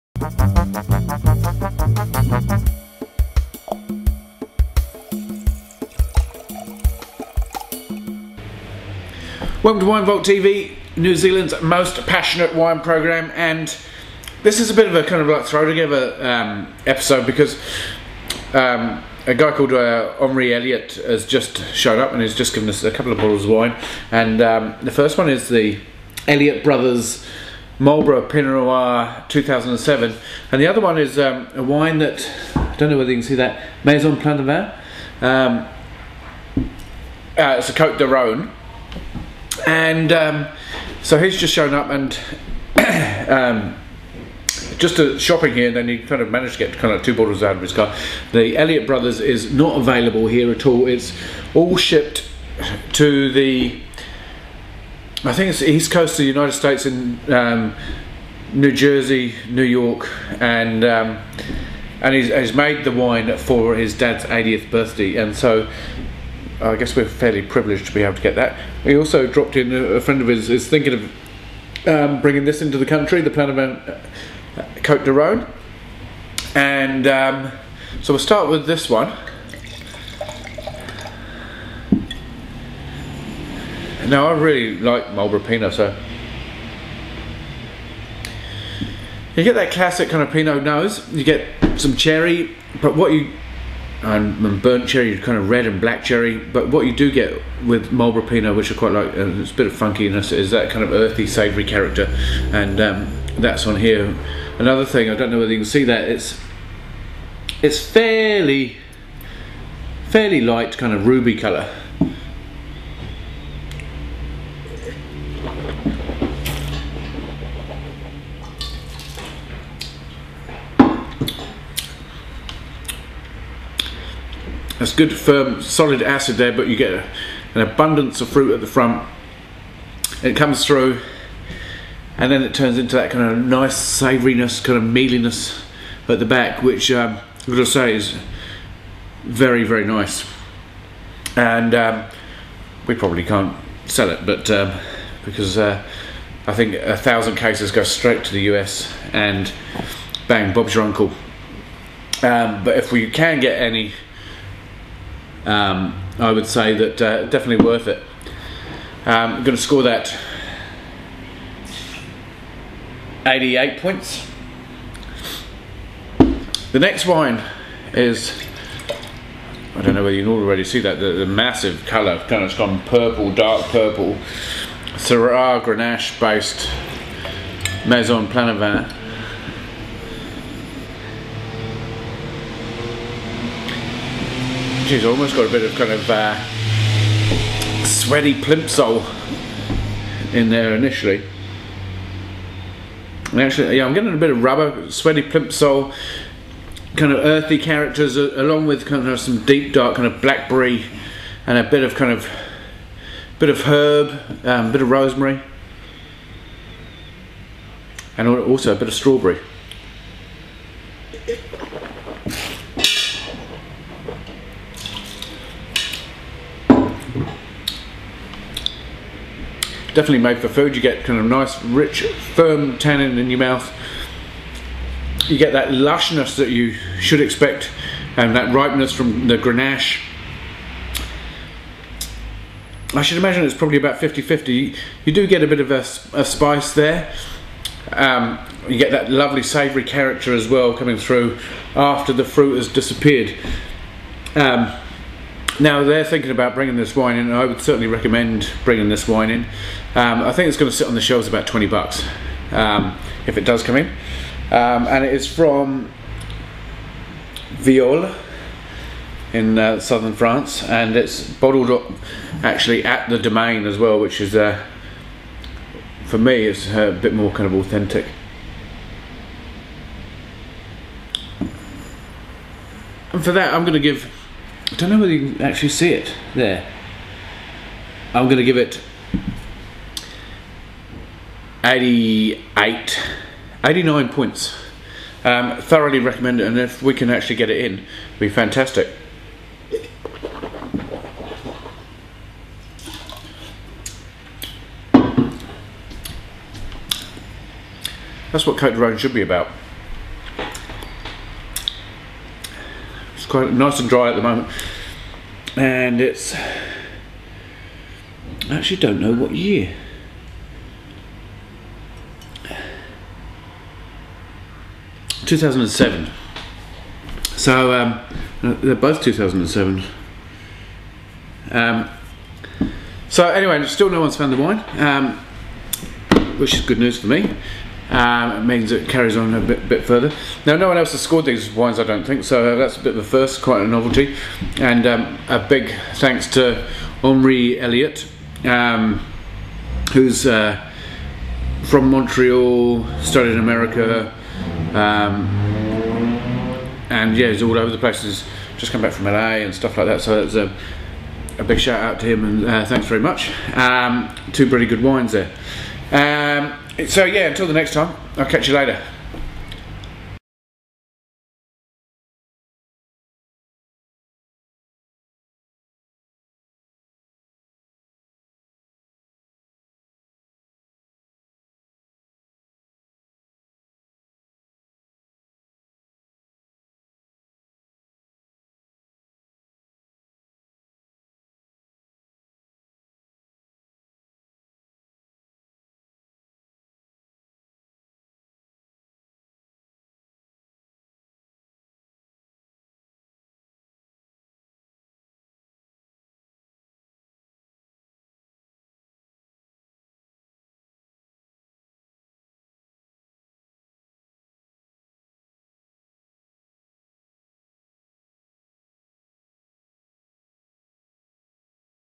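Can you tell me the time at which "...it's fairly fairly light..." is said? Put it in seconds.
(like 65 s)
107 s.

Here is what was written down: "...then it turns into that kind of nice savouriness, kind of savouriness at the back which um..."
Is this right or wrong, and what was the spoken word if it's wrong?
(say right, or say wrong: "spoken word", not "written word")
wrong: "mealiness", not "savouriness".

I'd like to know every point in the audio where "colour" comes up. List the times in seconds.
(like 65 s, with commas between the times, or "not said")
111 s, 171 s.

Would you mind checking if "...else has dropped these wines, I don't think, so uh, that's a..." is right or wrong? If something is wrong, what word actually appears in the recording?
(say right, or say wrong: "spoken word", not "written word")
wrong: "scored", not "dropped".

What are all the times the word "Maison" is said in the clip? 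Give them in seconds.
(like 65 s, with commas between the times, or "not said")
33 s, 177 s.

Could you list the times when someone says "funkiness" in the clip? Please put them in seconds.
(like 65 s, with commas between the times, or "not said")
99 s.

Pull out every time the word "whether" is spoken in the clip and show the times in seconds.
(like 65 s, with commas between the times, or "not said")
32 s, 105 s, 170 s, 274 s.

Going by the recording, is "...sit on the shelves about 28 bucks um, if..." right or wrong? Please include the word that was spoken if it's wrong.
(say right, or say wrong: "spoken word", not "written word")
wrong: "20", not "28".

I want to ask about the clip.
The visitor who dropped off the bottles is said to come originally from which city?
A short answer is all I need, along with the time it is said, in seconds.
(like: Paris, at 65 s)
Montreal, at 341 s.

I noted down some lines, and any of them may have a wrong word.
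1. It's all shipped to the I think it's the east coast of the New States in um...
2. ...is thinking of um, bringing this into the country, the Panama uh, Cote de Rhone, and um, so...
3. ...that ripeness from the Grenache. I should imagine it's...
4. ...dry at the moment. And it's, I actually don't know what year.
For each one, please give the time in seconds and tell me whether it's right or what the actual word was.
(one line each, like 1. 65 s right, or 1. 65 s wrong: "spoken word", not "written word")
1. 50 s wrong: "United", not "New"
2. 70 s right
3. 228 s right
4. 303 s right.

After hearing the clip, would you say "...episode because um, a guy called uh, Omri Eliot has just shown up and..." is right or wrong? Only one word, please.
right.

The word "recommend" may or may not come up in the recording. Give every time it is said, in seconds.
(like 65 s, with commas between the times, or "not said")
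247 s, 285 s.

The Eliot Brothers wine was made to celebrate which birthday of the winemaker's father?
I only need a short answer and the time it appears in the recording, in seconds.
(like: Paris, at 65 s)
80th, at 64 s.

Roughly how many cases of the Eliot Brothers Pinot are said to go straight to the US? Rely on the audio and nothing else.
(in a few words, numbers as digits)
1000.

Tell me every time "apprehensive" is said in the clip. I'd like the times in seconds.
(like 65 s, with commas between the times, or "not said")
not said.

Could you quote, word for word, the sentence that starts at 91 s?
You get some cherry, but what you and burnt cherry, kind of red and black cherry.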